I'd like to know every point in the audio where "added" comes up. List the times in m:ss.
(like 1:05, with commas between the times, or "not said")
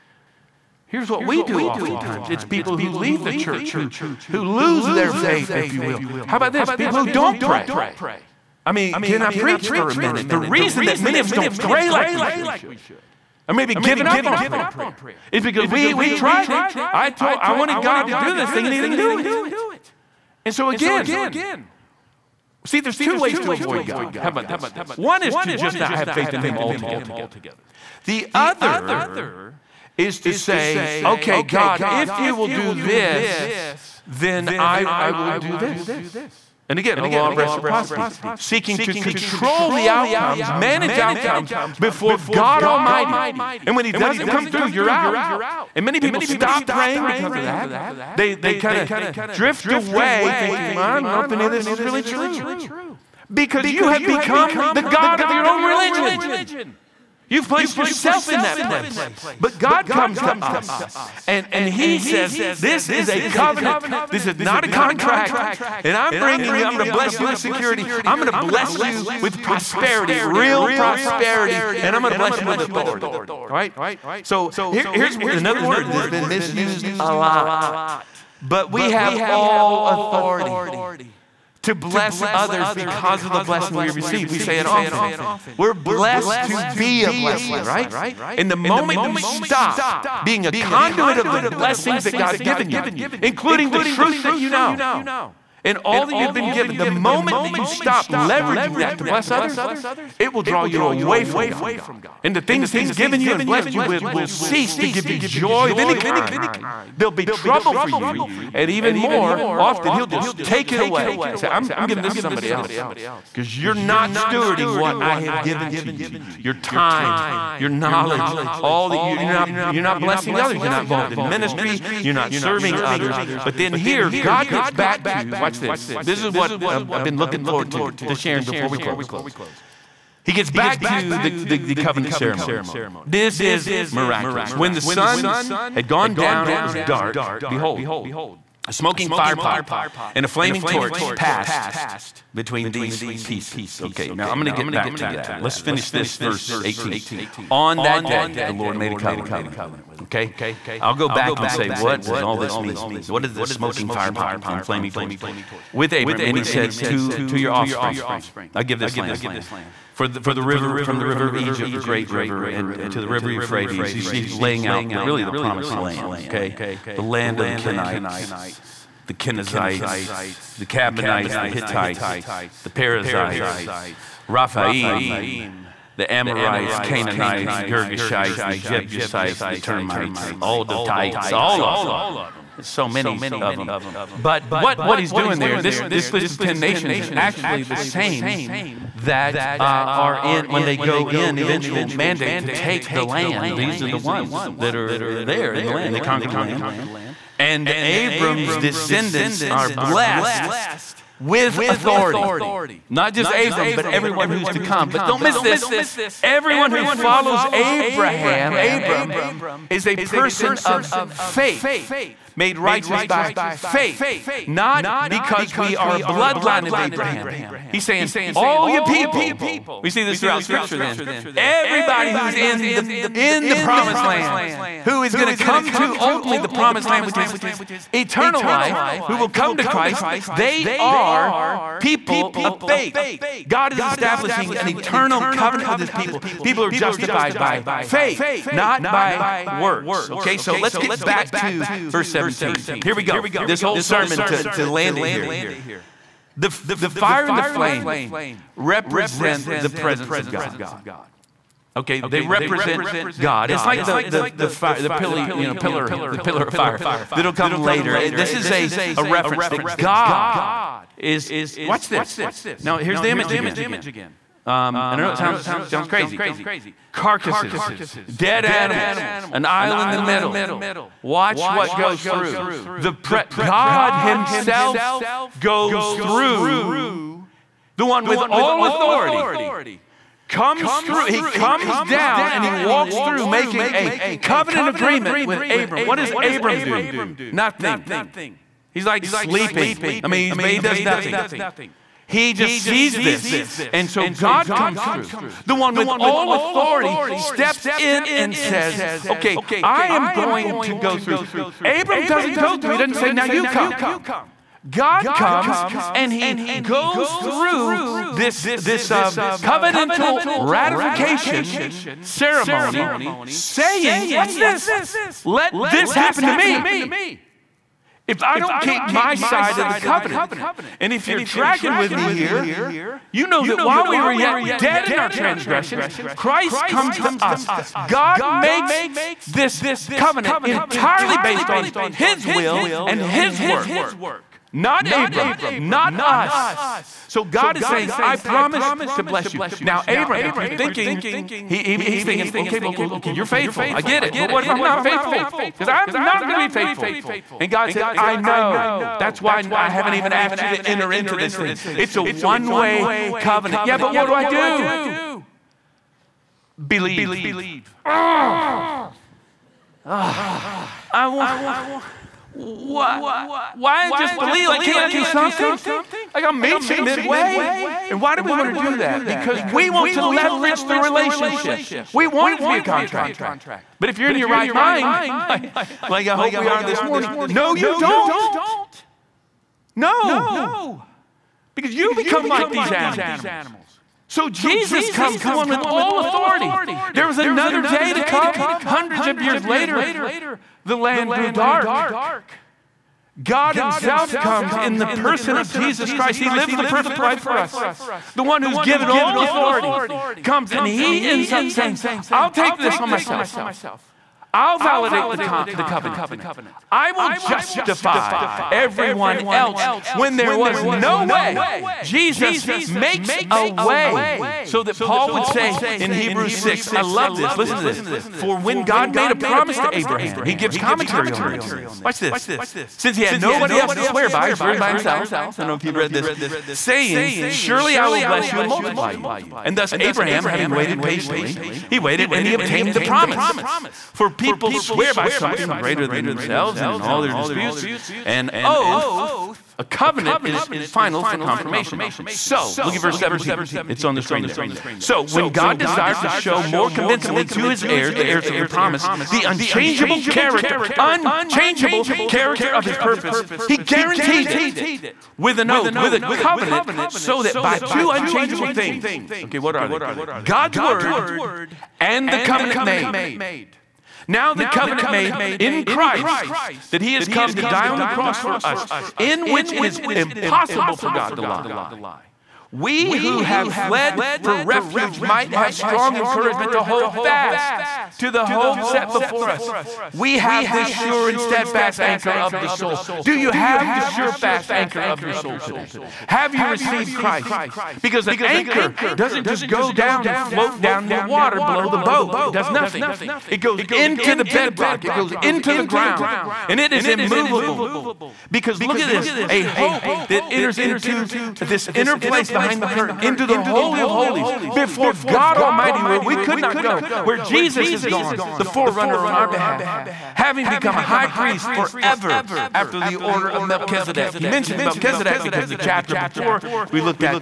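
not said.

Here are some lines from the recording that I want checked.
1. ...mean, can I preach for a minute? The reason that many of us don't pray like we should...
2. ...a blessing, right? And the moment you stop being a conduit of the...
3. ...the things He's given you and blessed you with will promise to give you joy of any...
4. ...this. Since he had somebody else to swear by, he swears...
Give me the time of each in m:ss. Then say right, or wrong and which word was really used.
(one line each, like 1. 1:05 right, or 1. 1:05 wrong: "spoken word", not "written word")
1. 0:08 right
2. 1:27 right
3. 1:42 wrong: "cease", not "promise"
4. 7:01 wrong: "nobody", not "somebody".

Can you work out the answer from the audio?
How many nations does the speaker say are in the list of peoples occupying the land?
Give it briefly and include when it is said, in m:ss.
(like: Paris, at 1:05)
10, at 3:06.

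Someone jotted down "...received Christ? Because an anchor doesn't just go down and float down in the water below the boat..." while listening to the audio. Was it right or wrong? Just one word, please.
right.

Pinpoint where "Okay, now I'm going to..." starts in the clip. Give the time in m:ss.
2:23.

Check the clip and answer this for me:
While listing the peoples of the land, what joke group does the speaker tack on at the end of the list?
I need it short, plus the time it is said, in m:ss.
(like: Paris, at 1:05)
the termites, at 2:59.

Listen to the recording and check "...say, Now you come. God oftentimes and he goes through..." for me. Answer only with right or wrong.
wrong.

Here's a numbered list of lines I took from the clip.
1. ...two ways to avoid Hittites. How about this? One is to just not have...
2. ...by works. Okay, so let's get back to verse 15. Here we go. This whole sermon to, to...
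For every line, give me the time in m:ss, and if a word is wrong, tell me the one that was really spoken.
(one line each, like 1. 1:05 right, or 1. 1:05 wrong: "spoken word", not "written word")
1. 0:22 wrong: "God", not "Hittites"
2. 3:58 wrong: "17", not "15".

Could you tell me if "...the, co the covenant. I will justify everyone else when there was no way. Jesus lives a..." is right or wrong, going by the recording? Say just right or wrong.
wrong.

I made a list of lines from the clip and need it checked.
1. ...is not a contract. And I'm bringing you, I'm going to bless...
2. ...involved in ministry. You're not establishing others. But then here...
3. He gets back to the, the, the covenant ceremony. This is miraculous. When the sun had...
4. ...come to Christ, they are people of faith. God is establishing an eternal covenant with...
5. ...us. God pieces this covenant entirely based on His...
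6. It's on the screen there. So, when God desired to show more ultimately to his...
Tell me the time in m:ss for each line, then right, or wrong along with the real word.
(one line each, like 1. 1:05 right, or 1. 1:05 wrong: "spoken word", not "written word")
1. 1:04 right
2. 2:00 wrong: "serving", not "establishing"
3. 2:10 right
4. 3:49 right
5. 5:27 wrong: "makes", not "pieces"
6. 7:23 wrong: "convincingly", not "ultimately".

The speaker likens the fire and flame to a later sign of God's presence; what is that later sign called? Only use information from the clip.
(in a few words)
pillar of fire.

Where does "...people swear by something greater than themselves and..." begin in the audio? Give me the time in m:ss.
7:14.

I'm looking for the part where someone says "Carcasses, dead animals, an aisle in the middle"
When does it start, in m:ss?
4:26.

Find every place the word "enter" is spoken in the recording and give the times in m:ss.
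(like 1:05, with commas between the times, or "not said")
5:50, 8:20.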